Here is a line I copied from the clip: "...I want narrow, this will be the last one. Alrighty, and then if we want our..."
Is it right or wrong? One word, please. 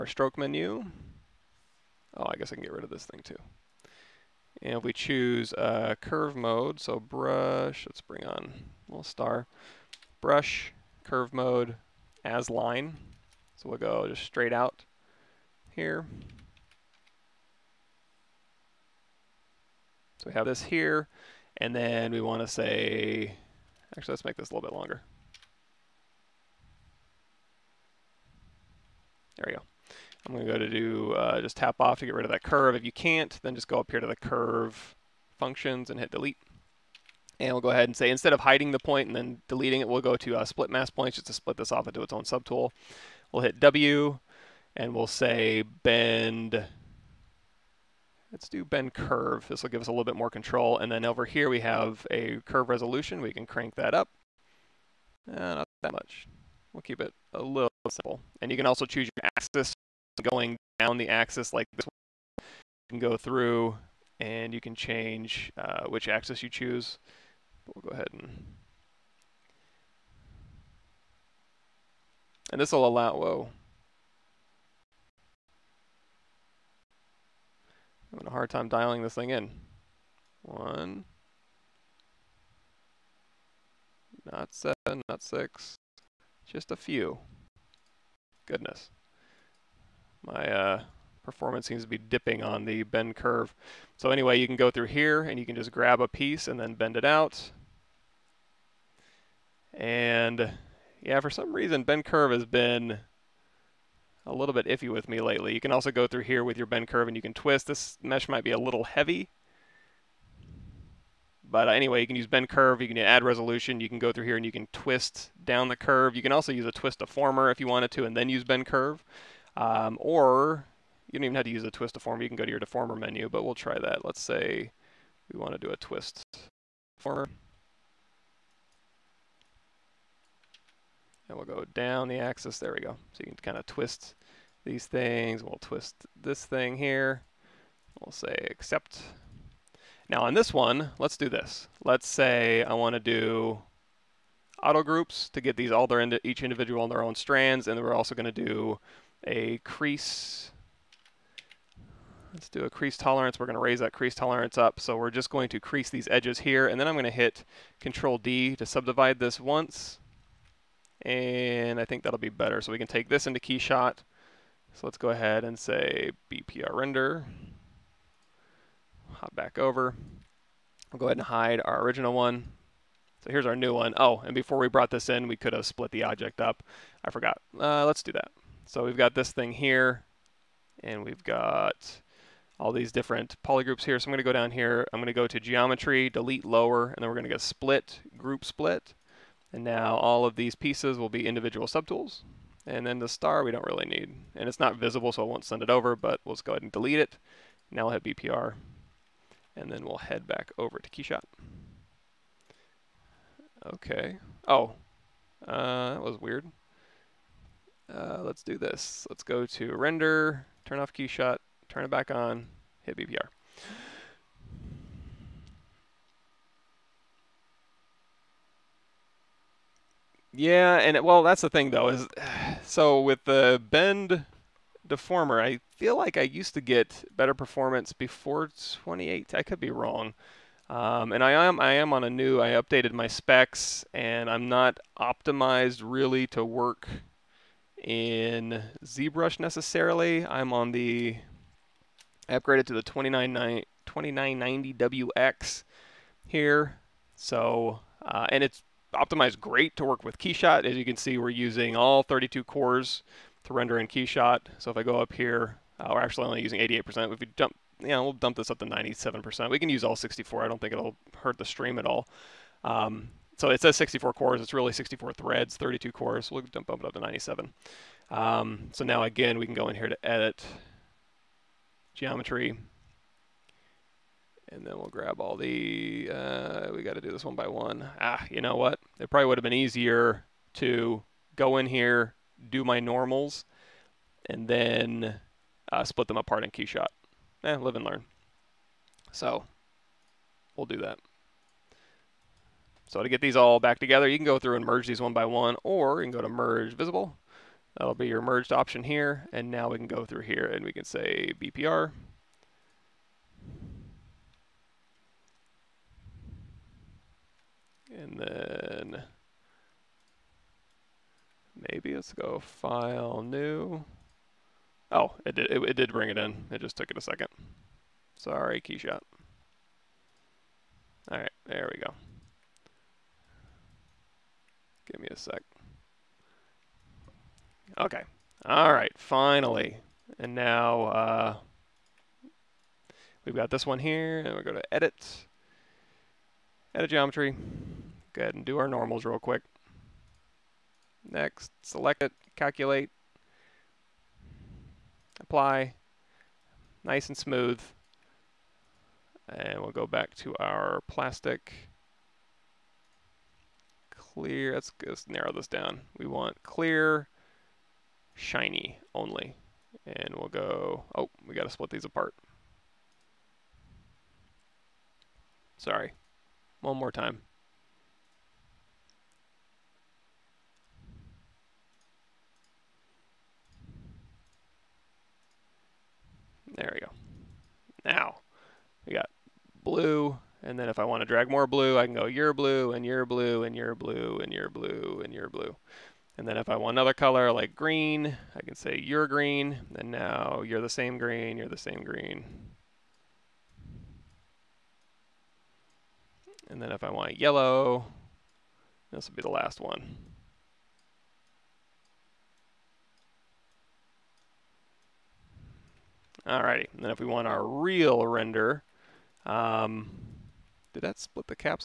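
wrong.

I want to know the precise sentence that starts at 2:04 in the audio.
Let's say we want to do a twist deformer.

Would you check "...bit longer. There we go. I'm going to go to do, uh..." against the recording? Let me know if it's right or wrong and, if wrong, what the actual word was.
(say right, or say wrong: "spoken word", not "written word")
right.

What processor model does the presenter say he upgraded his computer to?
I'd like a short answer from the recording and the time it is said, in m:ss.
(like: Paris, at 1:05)
2990WX, at 4:02.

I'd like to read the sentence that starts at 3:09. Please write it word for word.
And now all of these pieces will be individual subtools.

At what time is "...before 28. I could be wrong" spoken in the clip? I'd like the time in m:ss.
3:47.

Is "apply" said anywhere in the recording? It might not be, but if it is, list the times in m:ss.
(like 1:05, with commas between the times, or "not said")
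5:45.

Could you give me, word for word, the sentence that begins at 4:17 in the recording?
If we dump, we'll dump this up to 97%.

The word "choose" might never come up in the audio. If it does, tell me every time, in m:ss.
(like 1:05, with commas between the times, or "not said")
0:04, 0:58, 1:06.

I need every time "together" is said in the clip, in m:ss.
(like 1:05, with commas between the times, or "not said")
4:53.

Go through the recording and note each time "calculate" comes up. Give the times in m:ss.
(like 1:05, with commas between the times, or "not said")
5:42.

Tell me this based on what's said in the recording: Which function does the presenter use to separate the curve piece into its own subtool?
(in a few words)
Split masked points.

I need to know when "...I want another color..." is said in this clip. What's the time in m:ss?
6:26.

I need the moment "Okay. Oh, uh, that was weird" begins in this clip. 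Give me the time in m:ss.
3:23.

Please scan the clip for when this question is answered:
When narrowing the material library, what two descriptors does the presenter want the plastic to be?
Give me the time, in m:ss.
5:56.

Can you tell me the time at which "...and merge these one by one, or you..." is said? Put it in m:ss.
4:54.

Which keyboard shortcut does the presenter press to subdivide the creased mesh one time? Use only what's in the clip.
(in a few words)
Control D.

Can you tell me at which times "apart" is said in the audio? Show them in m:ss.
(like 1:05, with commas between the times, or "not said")
4:46, 6:01.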